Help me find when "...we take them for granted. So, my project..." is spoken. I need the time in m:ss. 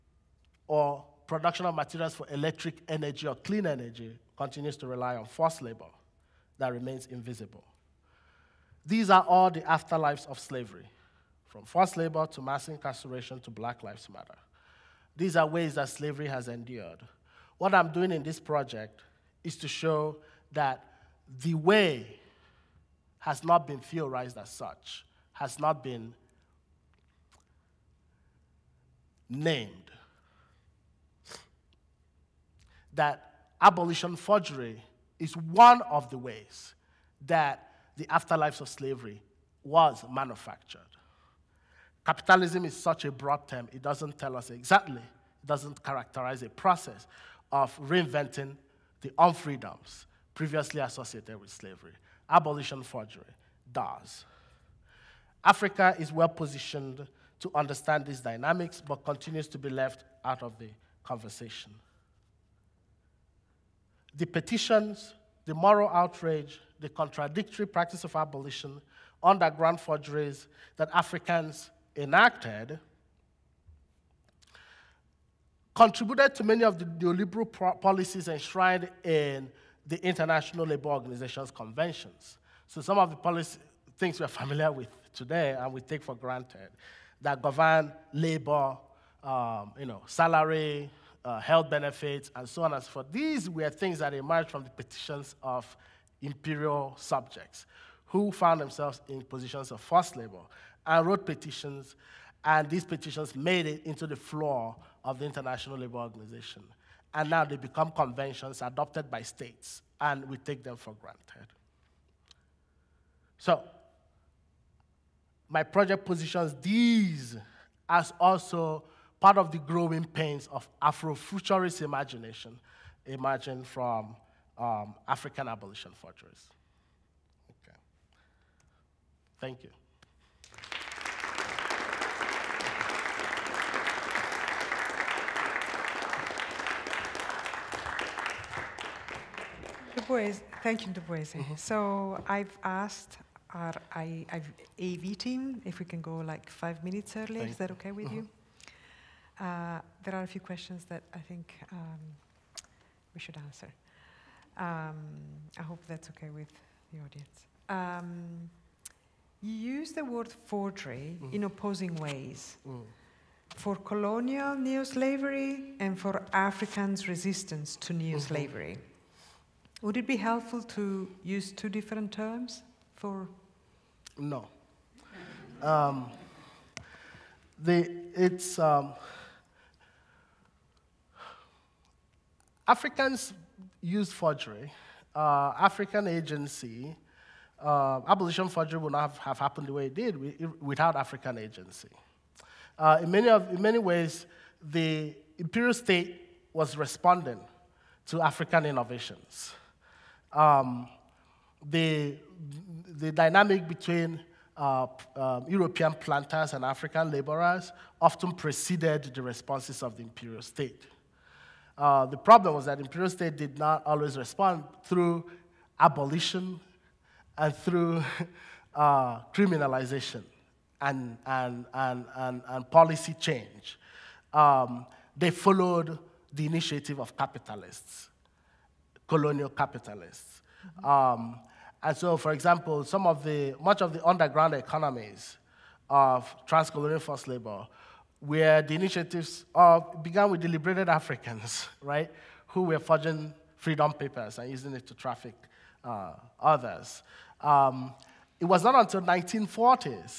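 1:50.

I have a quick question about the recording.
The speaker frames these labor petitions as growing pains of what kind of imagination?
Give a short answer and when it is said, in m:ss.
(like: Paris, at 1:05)
Afrofuturist, at 2:00.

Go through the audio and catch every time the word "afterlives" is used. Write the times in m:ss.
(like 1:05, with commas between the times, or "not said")
0:09, 0:38.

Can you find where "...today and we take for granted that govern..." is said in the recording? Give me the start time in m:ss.
1:25.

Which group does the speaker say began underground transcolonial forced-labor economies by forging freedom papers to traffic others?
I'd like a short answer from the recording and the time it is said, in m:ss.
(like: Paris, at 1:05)
Liberated Africans, at 4:00.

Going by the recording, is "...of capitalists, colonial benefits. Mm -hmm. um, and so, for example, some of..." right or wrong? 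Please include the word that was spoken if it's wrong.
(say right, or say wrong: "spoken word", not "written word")
wrong: "capitalists", not "benefits".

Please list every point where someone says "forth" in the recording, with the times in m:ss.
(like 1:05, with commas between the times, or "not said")
1:32.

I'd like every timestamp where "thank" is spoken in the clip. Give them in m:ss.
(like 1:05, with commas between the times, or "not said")
2:09, 2:20, 2:27.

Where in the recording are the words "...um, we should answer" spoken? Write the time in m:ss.
2:31.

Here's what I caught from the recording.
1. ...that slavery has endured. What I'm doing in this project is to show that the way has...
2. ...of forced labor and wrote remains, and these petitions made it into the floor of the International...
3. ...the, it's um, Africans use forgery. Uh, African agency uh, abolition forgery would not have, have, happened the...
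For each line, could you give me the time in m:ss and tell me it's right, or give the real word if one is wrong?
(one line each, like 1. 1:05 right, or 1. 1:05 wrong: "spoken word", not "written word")
1. 0:15 right
2. 1:39 wrong: "petitions", not "remains"
3. 2:57 right.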